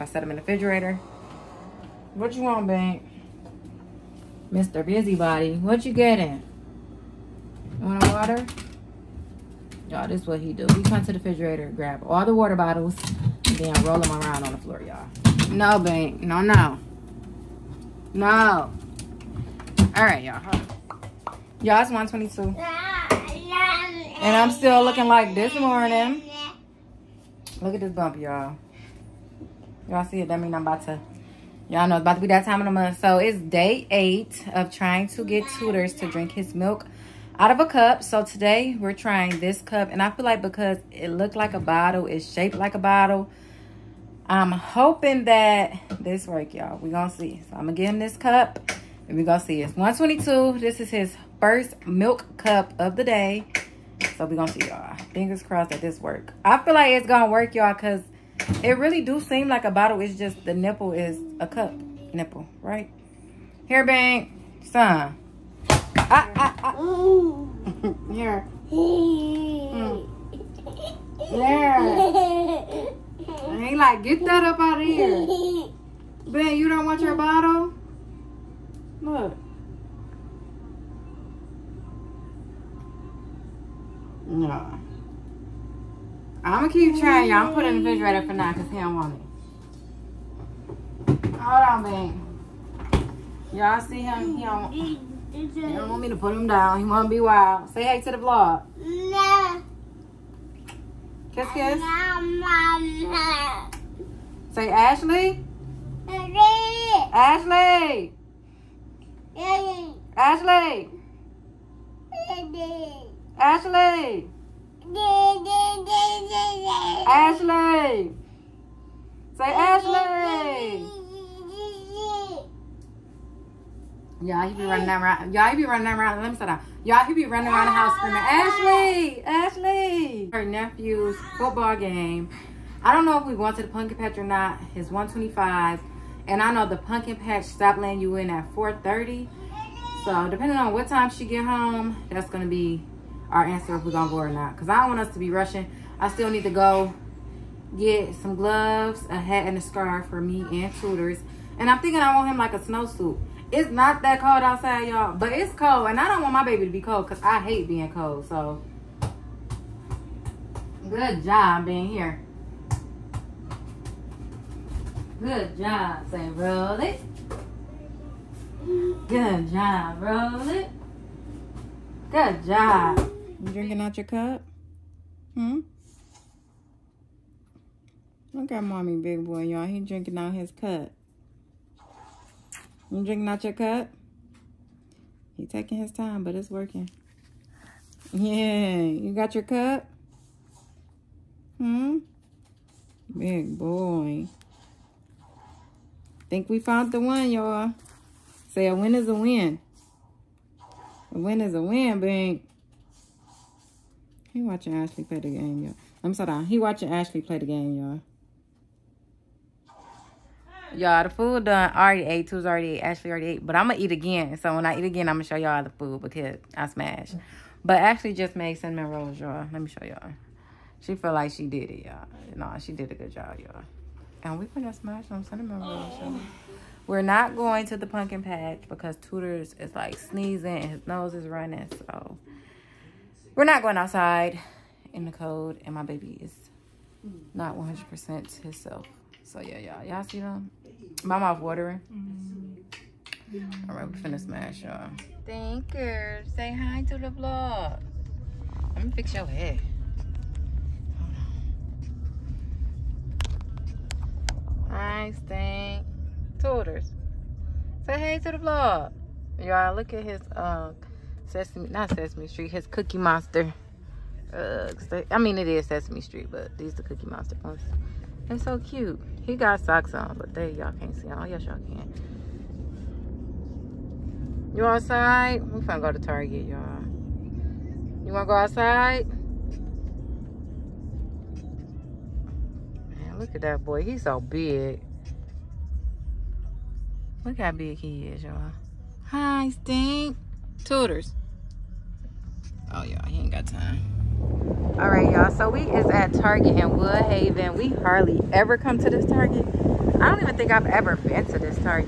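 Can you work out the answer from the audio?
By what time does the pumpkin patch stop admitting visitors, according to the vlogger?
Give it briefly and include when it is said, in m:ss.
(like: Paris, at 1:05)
4:30, at 2:18.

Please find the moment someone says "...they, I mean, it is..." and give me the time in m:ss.
4:24.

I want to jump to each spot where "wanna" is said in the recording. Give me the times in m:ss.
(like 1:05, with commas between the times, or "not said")
1:36, 4:38.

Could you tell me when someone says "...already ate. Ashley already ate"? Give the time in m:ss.
3:32.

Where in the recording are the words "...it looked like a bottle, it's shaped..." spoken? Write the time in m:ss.
0:40.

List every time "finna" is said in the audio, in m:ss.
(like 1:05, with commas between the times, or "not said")
4:03, 4:35.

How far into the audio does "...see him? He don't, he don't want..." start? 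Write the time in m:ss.
1:33.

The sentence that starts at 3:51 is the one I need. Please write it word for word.
So we're not going outside in the cold, and my baby is not 100% himself.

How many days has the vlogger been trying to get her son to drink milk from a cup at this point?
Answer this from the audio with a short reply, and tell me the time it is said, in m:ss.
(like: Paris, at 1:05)
8, at 0:33.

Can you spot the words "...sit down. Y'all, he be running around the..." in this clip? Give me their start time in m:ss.
2:06.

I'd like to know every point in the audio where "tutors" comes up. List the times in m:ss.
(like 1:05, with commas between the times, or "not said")
0:35, 2:30, 4:16, 4:50.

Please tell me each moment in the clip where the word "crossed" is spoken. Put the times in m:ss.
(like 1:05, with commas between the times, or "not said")
0:55.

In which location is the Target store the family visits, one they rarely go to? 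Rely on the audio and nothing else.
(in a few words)
Woodhaven.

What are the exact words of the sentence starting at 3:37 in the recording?
But Ashley just made cinnamon rolls, y'all.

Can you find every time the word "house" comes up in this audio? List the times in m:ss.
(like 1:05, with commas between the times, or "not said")
2:07.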